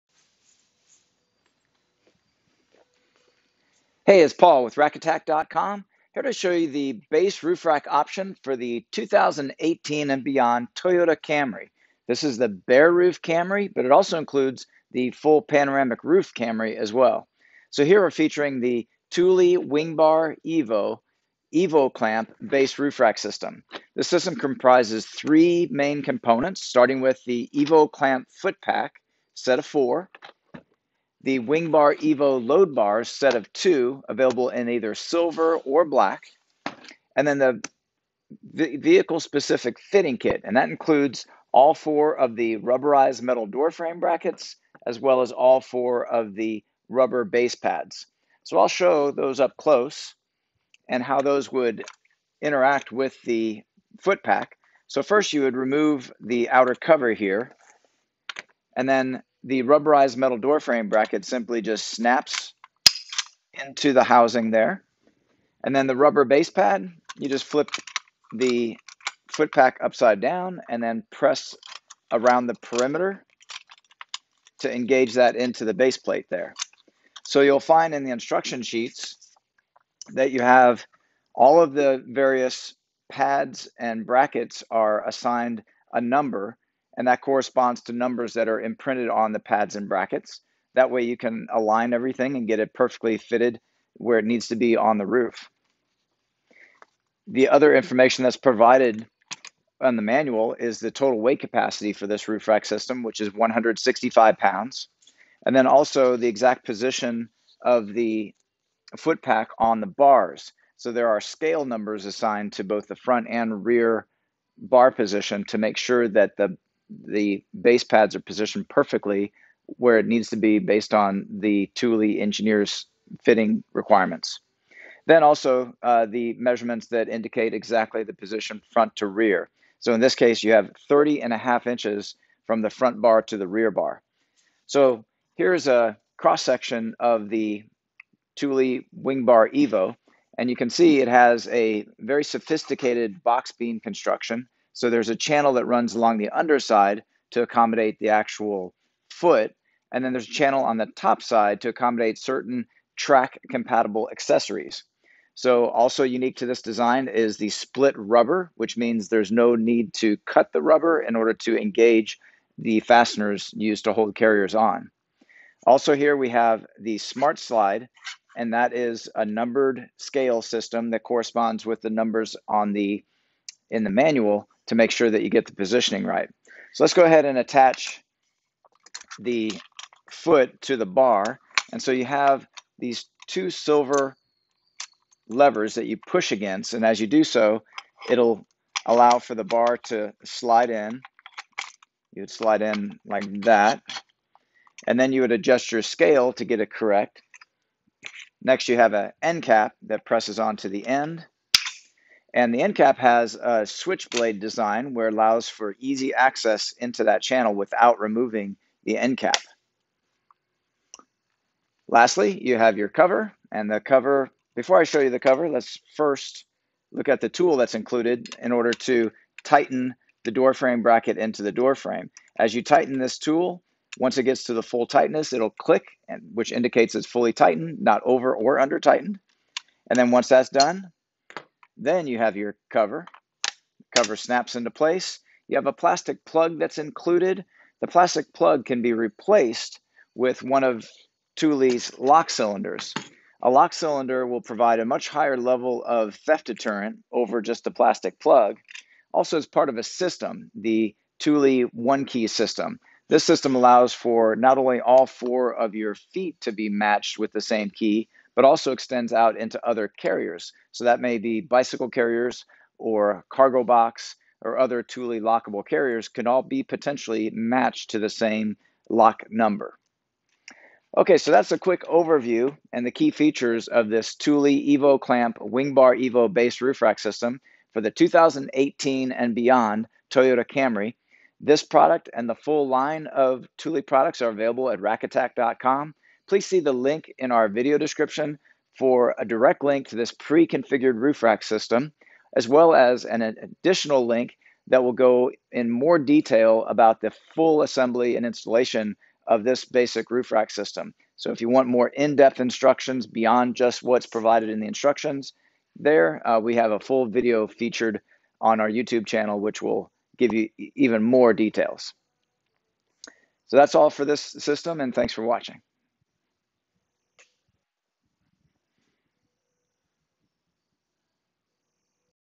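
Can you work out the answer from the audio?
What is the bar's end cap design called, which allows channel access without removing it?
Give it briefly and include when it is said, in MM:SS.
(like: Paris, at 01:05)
switchblade design, at 03:23.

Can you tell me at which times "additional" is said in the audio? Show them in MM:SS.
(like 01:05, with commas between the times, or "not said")
04:53.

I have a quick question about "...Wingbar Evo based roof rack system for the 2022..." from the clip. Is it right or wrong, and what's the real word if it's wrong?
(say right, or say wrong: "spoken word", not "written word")
wrong: "2018", not "2022".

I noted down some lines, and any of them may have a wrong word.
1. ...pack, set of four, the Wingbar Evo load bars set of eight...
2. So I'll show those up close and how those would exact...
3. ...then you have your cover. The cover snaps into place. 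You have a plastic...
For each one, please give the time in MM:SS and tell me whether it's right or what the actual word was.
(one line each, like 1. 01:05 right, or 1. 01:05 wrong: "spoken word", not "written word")
1. 00:28 wrong: "two", not "eight"
2. 00:48 wrong: "interact", not "exact"
3. 03:51 right.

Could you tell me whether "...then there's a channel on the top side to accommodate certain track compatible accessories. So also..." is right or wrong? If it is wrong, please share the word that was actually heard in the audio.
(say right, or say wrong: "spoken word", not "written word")
right.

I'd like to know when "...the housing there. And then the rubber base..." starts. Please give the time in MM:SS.
01:03.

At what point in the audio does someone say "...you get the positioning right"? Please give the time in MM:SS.
02:55.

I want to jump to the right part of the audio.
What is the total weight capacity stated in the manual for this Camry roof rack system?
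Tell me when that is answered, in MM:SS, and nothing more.
01:43.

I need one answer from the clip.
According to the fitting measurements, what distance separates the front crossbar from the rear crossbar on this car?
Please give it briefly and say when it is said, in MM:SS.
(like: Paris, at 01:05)
30.5 inches, at 02:10.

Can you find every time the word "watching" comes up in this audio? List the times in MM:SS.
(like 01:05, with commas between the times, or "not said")
05:15.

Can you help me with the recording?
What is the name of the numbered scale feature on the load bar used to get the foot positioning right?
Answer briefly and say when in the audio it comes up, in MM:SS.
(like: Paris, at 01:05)
smart slide, at 02:46.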